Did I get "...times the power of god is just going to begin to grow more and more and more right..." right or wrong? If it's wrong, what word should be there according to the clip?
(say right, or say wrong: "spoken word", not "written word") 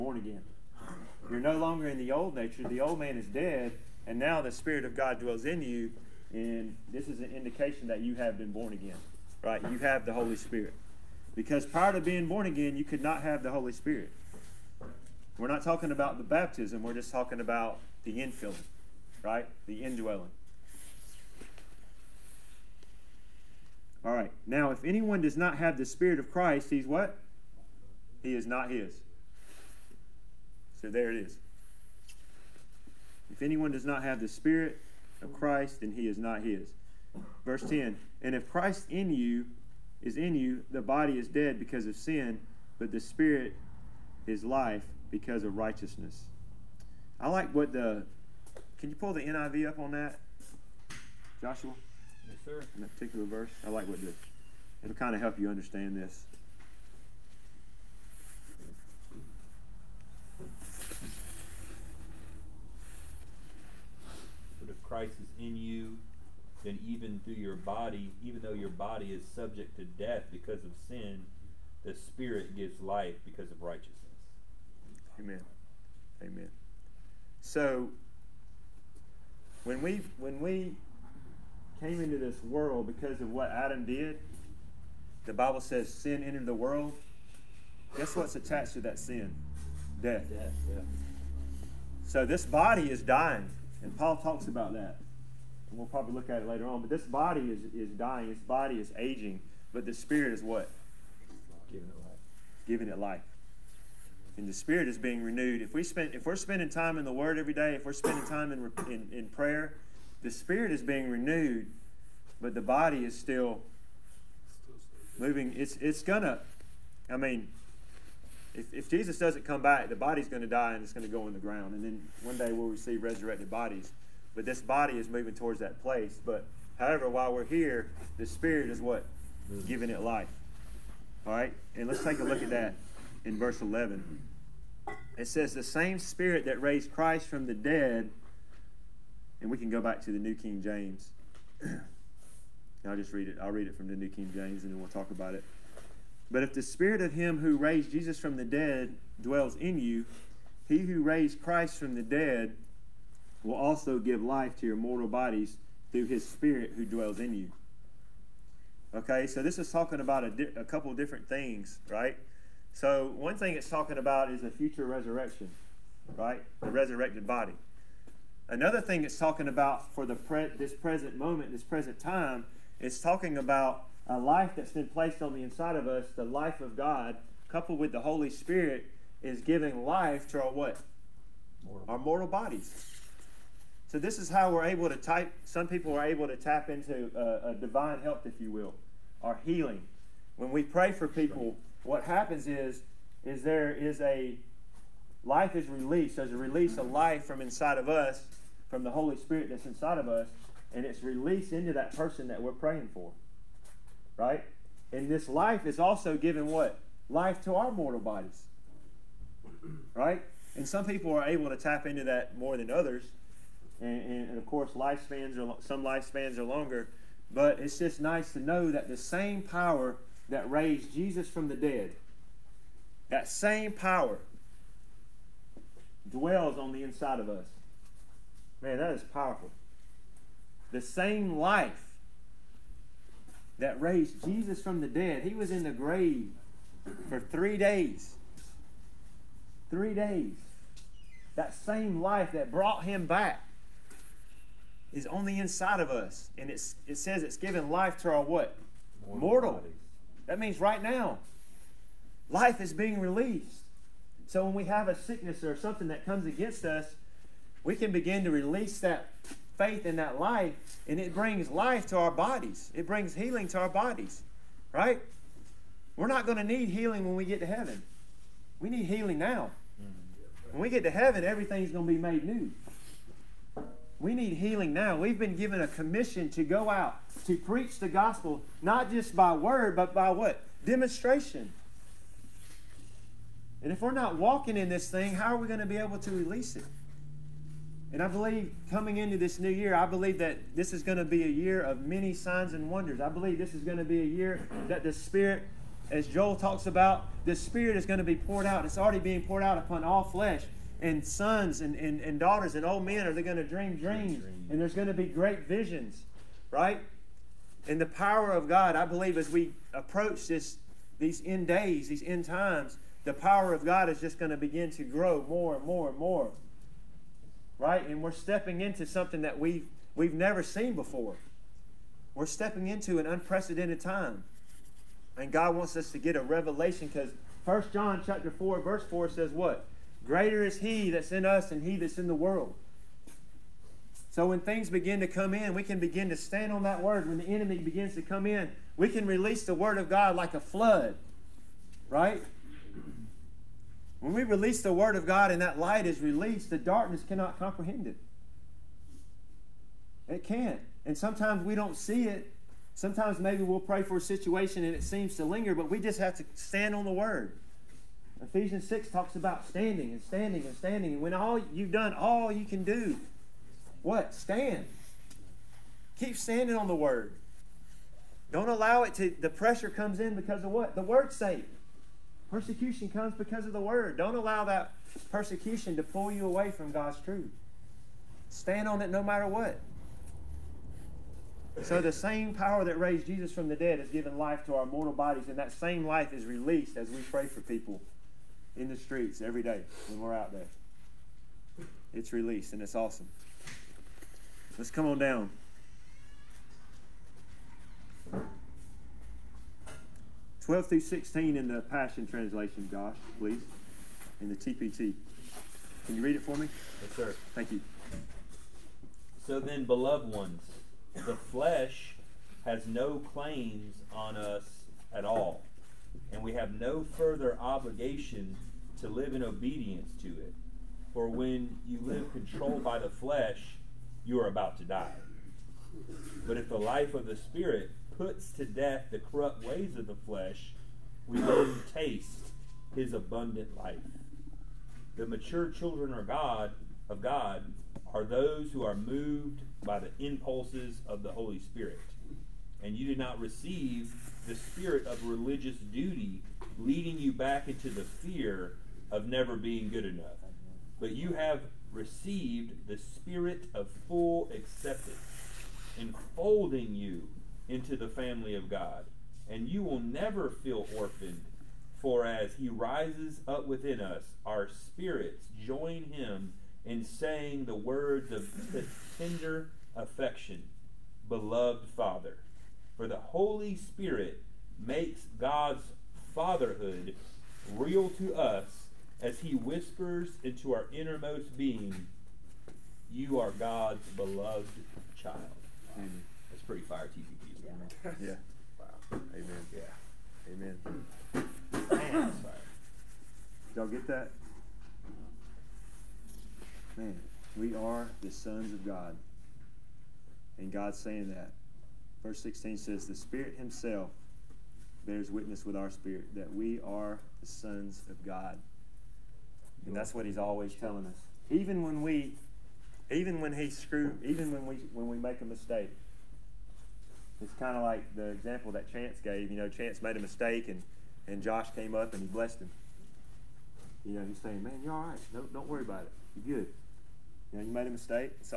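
right.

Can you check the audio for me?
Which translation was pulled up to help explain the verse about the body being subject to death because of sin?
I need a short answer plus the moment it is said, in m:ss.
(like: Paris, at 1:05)
NIV, at 0:49.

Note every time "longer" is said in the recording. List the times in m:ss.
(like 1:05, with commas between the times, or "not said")
0:01, 3:36.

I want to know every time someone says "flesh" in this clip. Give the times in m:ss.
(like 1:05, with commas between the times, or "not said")
5:00, 6:51, 7:02, 7:09.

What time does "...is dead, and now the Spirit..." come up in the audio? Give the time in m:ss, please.
0:03.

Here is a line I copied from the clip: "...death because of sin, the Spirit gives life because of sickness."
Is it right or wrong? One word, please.
wrong.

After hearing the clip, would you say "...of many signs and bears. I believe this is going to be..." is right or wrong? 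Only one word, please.
wrong.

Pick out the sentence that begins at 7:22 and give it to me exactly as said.
And you did not receive the spirit of religious duty leading you back into the fear of never being good enough.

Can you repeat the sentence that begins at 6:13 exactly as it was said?
Don't allow that persecution to pull you away from God's truth.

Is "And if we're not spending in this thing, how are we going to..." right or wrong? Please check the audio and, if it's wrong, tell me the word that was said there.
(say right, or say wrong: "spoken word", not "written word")
wrong: "walking", not "spending".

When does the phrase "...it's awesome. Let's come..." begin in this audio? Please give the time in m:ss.
6:32.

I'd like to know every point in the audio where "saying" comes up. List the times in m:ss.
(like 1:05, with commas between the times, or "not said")
7:46, 8:20, 8:44.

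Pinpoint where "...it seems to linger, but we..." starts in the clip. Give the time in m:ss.
5:54.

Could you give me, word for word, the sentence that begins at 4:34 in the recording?
We've been given a commission to go out to preach the gospel, not just by word, but by what?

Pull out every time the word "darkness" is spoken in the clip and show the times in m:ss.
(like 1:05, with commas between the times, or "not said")
5:46.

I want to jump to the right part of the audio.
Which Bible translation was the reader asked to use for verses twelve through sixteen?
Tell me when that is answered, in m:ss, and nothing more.
6:41.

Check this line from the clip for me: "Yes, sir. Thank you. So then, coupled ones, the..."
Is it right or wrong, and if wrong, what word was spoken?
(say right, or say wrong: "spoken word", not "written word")
wrong: "beloved", not "coupled".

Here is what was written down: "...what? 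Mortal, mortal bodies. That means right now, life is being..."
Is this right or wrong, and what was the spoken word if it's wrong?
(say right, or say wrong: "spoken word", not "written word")
right.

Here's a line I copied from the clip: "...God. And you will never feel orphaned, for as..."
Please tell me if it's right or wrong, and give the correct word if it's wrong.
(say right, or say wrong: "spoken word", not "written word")
right.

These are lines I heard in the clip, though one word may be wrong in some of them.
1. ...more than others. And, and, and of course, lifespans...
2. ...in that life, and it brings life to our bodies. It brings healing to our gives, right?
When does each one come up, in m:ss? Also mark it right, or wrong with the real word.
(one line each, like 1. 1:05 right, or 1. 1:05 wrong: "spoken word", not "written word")
1. 3:32 right
2. 4:19 wrong: "bodies", not "gives".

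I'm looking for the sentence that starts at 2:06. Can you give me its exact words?
But however, while we're here, the spirit is what mm.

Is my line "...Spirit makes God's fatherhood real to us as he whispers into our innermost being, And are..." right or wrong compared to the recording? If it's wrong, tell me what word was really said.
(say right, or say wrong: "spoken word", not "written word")
wrong: "You", not "And".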